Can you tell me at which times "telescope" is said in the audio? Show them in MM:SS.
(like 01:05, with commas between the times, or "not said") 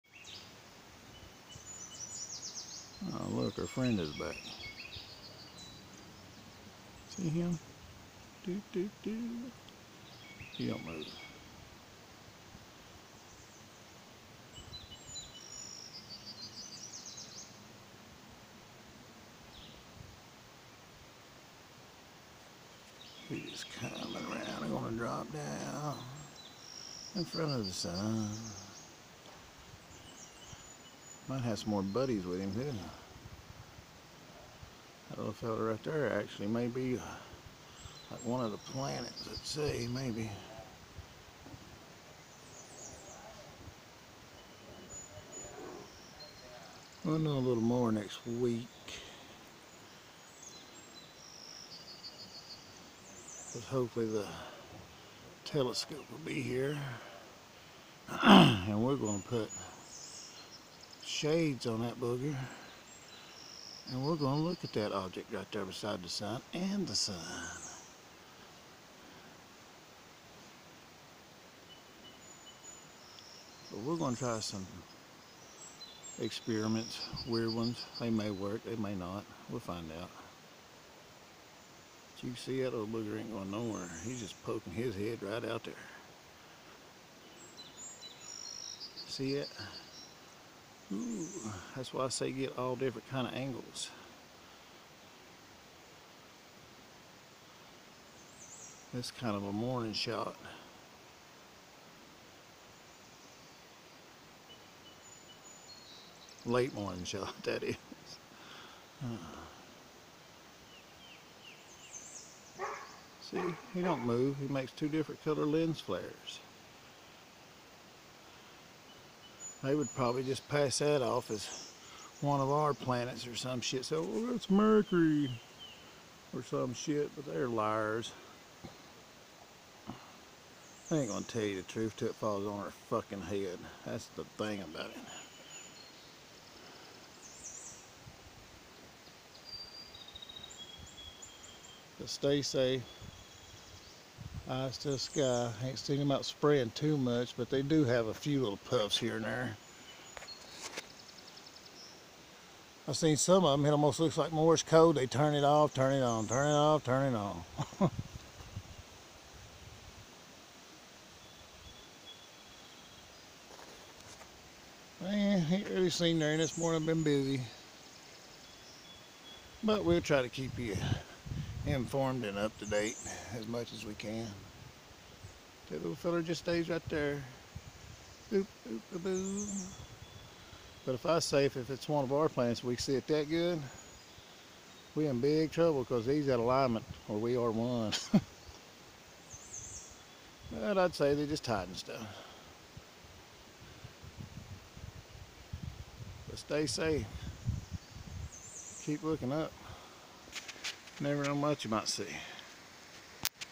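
00:55.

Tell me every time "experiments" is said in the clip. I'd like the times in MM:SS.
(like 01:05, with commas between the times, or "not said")
01:16.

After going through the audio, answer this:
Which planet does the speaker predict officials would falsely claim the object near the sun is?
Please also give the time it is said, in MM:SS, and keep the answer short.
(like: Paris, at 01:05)
Mercury, at 02:04.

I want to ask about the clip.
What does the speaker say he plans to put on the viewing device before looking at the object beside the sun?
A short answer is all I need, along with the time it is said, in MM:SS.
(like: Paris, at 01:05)
shades, at 01:01.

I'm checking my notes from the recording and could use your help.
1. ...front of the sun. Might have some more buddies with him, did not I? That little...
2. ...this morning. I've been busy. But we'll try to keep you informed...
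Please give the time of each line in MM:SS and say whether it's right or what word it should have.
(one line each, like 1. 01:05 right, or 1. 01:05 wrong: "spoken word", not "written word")
1. 00:27 right
2. 02:46 right.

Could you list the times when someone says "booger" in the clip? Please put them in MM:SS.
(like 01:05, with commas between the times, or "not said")
01:02, 01:22.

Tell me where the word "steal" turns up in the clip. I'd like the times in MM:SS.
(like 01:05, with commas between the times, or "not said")
not said.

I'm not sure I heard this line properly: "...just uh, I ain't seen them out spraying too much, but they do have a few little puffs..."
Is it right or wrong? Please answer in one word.
right.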